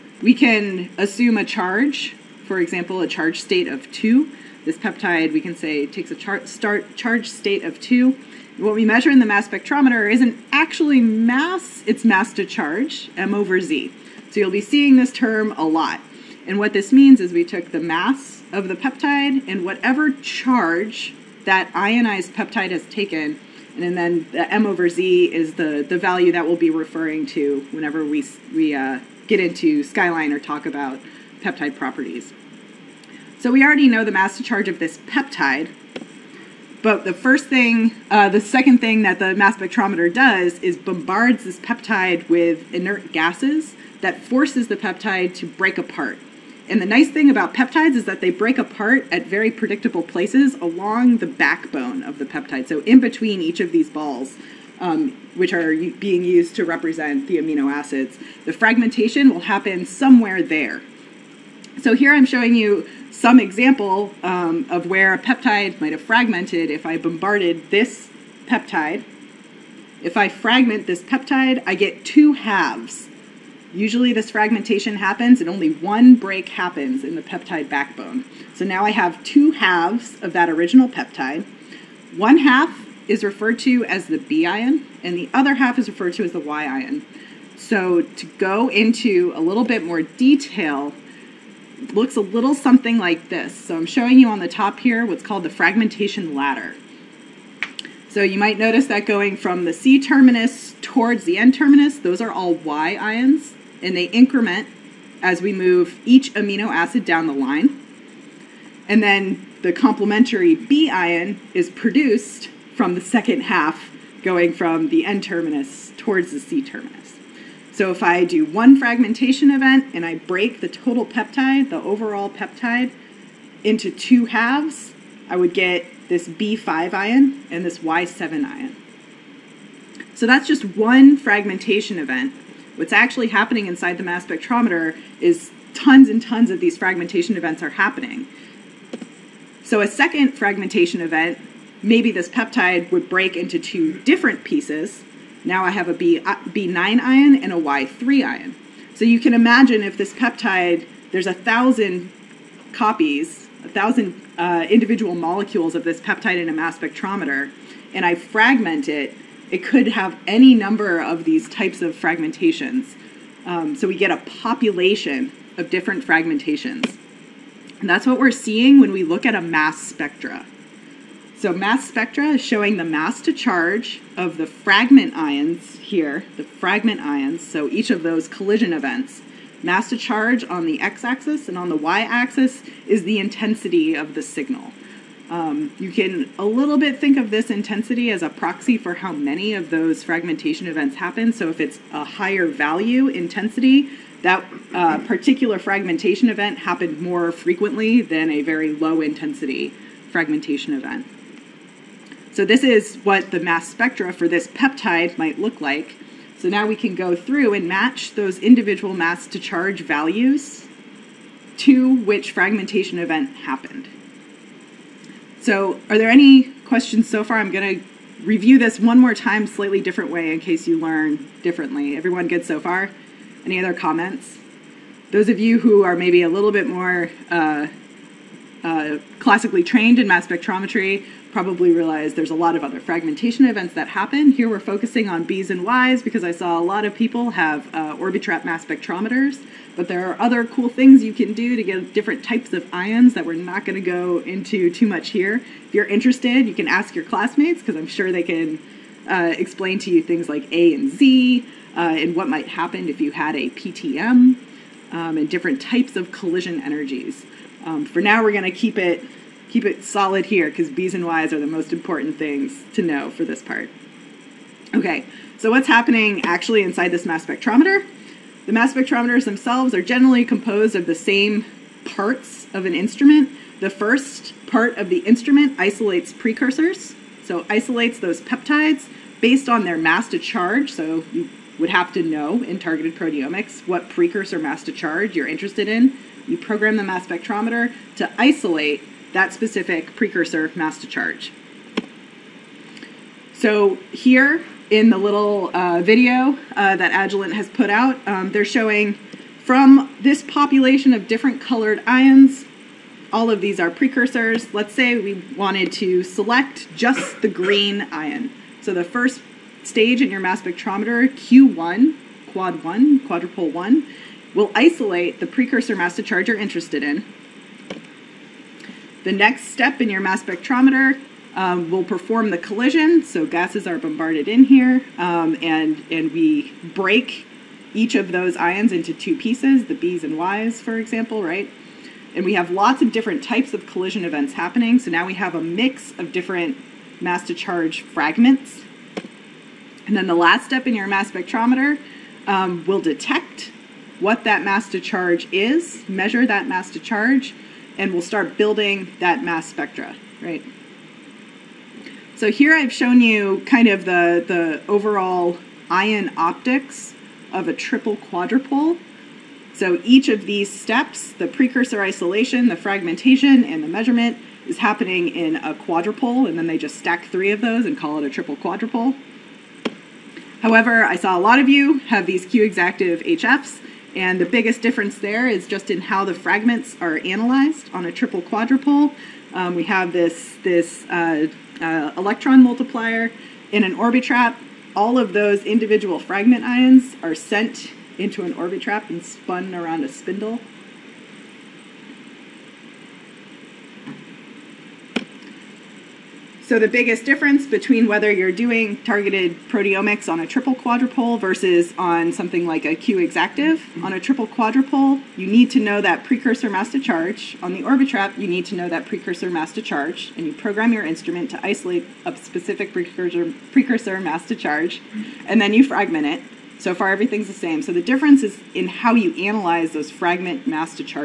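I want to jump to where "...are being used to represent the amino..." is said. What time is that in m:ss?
0:55.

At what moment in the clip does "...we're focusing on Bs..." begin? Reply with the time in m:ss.
3:54.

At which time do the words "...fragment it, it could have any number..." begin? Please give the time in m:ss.
2:38.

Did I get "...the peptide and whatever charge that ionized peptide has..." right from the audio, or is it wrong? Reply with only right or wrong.
right.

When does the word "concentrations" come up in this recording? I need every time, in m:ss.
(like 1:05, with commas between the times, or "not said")
not said.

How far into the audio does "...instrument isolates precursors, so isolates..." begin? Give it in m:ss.
4:35.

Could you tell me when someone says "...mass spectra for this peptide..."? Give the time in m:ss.
3:23.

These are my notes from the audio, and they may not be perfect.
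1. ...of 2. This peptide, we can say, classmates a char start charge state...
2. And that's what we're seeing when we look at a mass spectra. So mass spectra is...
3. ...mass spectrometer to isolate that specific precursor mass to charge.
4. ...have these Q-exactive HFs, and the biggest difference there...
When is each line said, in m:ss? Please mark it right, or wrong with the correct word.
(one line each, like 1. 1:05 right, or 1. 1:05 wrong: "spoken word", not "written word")
1. 0:03 wrong: "takes", not "classmates"
2. 2:47 right
3. 4:46 right
4. 6:11 right.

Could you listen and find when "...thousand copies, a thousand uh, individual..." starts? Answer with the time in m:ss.
2:31.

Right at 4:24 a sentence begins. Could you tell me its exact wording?
Okay, so what's happening actually inside this mass spectrometer?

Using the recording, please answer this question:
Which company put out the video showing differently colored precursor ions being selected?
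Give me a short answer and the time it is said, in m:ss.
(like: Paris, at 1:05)
Agilent, at 4:56.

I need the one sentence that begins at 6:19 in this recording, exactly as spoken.
Um, we have this, this uh, uh, electron multiplier in an orbitrap.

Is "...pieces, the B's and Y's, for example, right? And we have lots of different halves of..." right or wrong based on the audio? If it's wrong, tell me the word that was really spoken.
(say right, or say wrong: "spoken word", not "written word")
wrong: "types", not "halves".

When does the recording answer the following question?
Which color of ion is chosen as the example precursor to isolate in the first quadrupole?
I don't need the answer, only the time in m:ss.
5:07.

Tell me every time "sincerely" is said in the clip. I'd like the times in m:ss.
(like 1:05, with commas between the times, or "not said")
not said.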